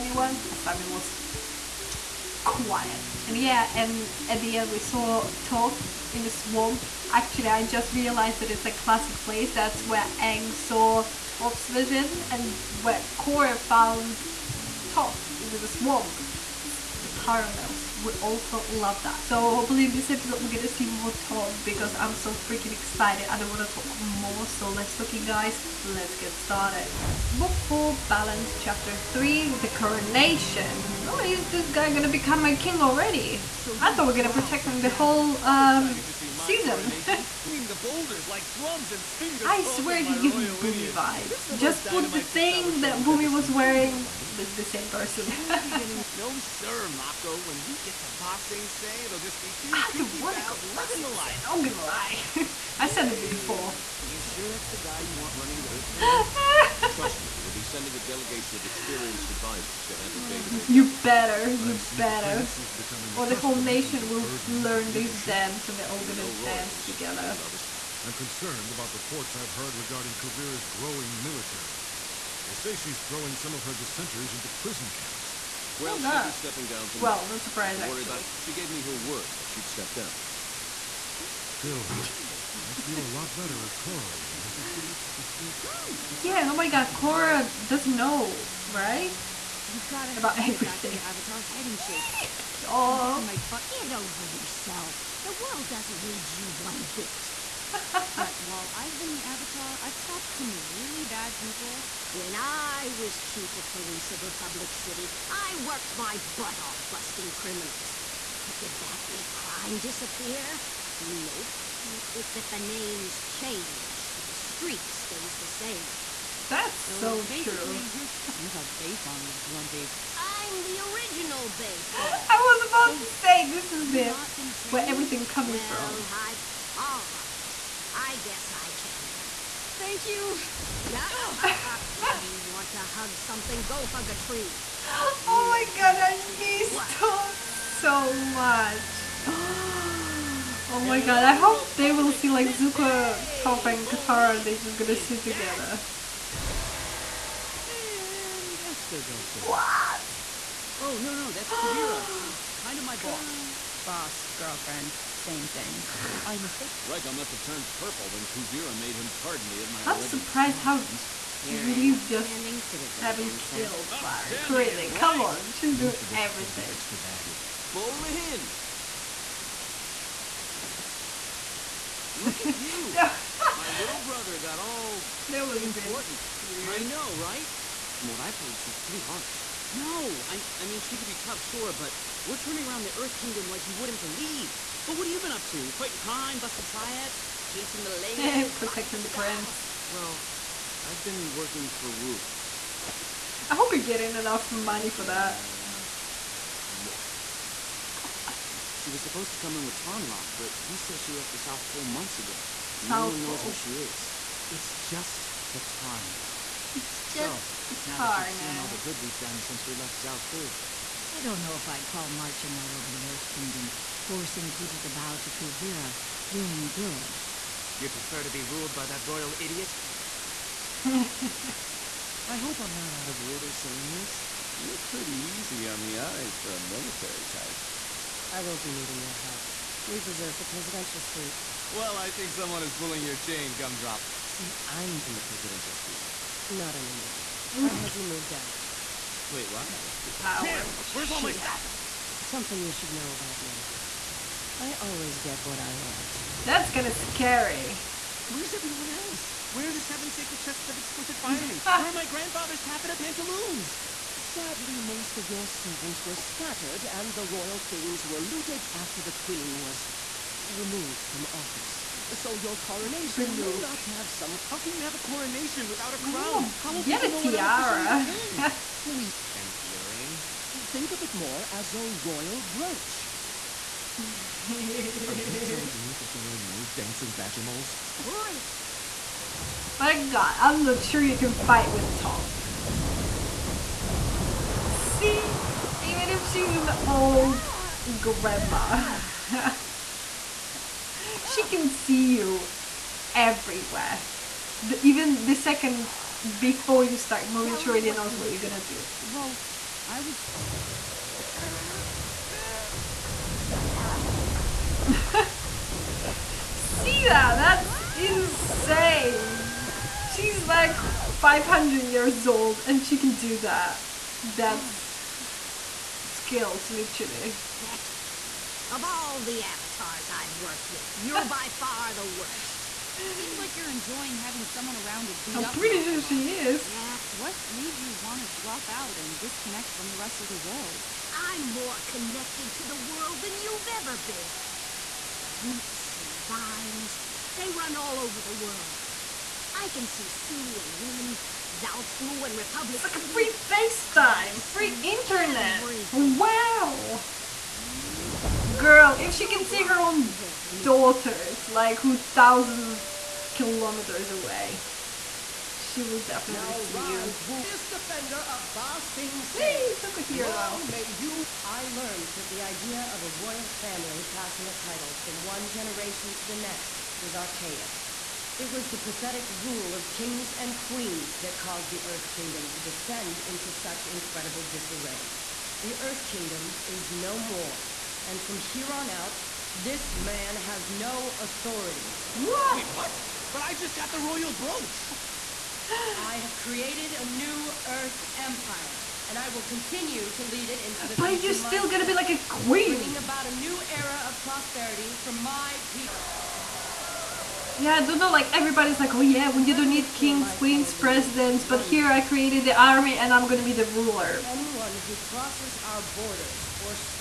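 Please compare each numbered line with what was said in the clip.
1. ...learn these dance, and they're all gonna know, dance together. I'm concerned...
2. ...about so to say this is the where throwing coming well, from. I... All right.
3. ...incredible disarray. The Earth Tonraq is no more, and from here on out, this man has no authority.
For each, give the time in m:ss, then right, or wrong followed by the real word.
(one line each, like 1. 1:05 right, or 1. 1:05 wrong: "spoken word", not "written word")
1. 1:04 right
2. 2:02 wrong: "everything", not "throwing"
3. 6:13 wrong: "Kingdom", not "Tonraq".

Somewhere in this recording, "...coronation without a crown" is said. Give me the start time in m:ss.
4:24.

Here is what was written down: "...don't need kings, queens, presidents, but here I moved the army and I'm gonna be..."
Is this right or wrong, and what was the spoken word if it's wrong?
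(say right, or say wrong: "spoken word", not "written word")
wrong: "created", not "moved".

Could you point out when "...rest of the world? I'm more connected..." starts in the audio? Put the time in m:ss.
5:29.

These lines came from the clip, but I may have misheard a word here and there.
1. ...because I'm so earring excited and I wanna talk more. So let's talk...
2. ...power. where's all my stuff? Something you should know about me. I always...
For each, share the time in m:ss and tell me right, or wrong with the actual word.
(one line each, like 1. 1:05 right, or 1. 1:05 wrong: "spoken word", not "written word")
1. 0:21 wrong: "freaking", not "earring"
2. 4:00 right.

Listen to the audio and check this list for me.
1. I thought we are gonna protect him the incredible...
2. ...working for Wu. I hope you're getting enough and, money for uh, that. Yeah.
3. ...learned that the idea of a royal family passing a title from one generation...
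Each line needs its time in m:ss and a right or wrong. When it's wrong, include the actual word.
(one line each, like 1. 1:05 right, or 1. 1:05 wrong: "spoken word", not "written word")
1. 0:33 wrong: "whole", not "incredible"
2. 3:11 right
3. 6:01 right.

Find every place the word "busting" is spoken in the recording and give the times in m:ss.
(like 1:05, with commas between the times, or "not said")
1:46, 3:06.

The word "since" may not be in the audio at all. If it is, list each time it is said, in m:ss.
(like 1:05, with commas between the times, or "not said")
3:29.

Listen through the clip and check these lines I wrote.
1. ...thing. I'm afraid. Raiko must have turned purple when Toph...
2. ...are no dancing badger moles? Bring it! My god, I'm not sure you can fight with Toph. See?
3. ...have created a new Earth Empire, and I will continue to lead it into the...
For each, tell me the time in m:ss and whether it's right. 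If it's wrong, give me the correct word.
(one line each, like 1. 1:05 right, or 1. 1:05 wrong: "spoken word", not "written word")
1. 2:35 wrong: "Kuvira", not "Toph"
2. 4:36 right
3. 6:26 right.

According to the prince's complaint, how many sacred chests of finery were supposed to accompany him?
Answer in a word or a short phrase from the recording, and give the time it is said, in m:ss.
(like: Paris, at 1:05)
7, at 4:09.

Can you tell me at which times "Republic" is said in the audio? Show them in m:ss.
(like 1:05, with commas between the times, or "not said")
1:44, 5:42.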